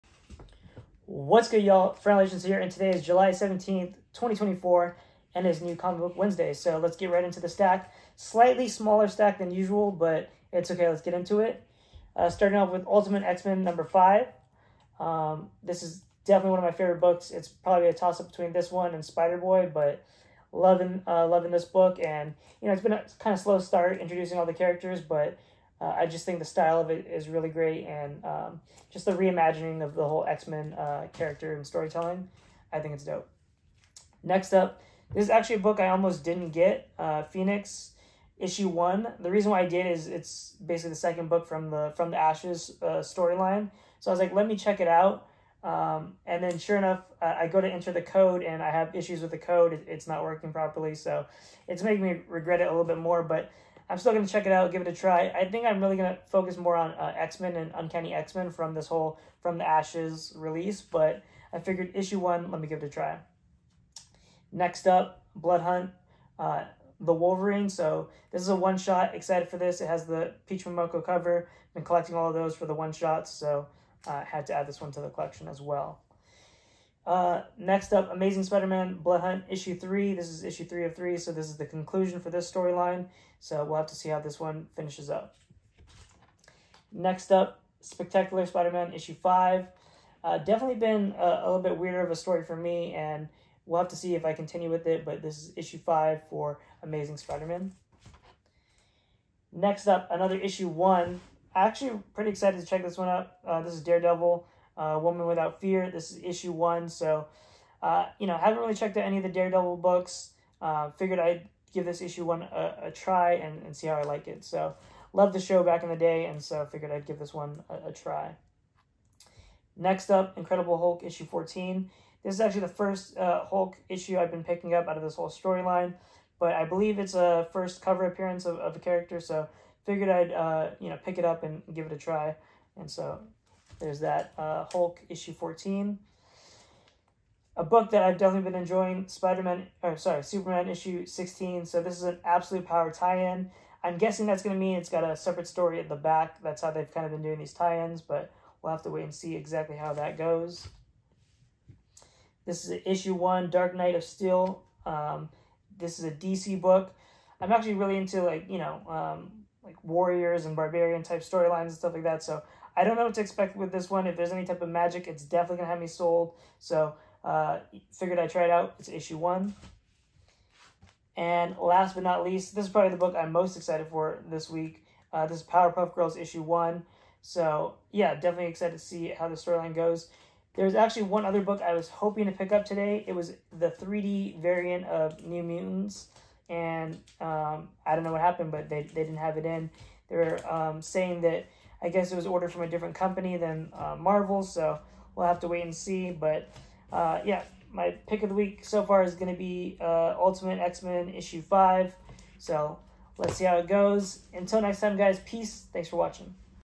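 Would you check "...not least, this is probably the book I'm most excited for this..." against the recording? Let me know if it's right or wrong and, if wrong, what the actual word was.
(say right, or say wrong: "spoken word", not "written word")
right.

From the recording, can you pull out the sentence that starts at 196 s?
But uh, yeah, my pick of the week so far is going to be uh, Ultimate X Men issue 5.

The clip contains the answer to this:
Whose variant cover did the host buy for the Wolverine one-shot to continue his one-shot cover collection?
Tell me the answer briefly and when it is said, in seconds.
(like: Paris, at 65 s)
Peach Momoko, at 70 s.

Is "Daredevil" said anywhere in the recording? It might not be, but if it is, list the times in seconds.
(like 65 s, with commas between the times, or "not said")
103 s, 109 s.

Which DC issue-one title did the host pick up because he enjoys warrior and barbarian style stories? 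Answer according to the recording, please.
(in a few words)
Dark Knight of Steel.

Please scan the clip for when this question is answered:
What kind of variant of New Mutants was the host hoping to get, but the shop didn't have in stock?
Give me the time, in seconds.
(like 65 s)
183 s.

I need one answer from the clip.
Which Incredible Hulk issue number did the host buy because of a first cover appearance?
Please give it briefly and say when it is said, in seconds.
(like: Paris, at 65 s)
14, at 120 s.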